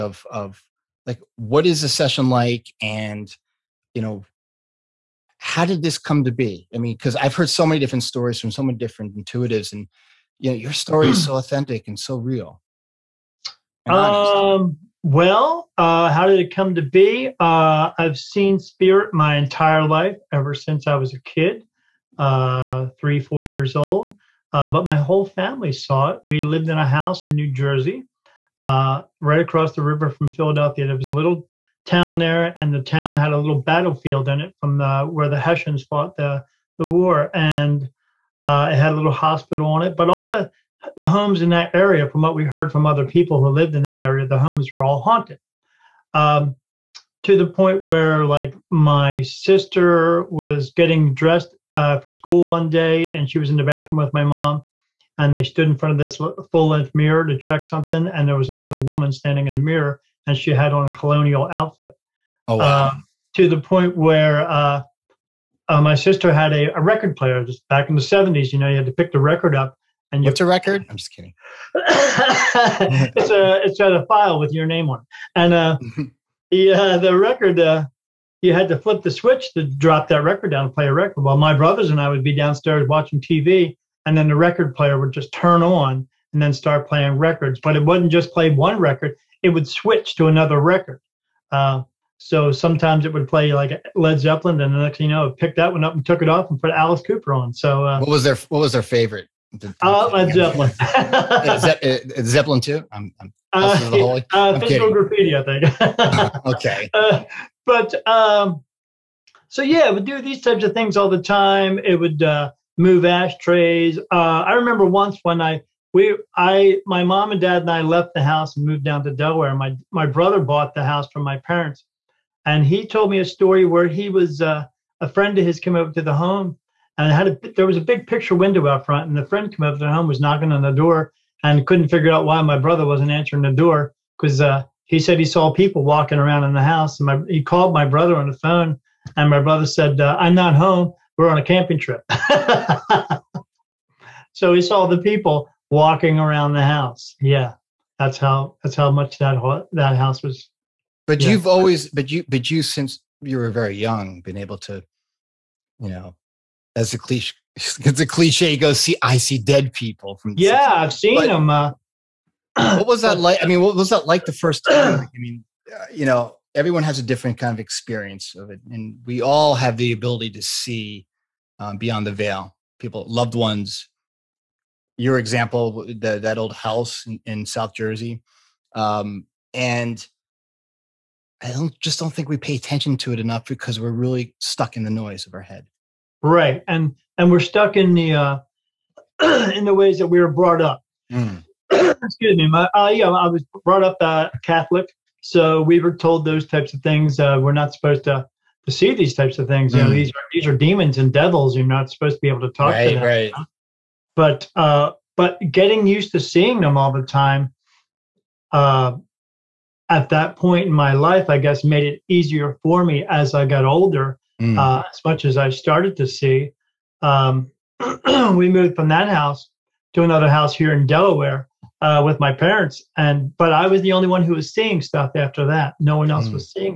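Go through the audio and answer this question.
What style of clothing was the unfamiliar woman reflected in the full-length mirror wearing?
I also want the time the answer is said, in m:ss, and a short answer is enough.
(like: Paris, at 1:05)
colonial outfit, at 1:00.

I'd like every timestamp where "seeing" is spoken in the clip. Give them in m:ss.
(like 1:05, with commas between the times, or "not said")
3:26, 3:44.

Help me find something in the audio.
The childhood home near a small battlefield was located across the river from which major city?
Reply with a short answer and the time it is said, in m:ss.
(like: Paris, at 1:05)
Philadelphia, at 0:30.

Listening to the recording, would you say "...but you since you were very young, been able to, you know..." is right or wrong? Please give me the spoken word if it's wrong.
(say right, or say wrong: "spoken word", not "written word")
right.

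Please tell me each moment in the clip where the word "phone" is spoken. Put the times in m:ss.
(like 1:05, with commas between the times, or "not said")
2:18.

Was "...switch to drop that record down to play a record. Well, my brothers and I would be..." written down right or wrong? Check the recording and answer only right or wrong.
right.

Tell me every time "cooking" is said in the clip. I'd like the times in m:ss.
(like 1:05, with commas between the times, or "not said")
not said.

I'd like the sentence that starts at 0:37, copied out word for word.
And uh, it had a little hospital on it.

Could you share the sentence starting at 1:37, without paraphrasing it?
So uh, what was their what was their favorite I'll Zeppelin.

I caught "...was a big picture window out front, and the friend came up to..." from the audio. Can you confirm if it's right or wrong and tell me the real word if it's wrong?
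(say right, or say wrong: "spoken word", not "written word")
right.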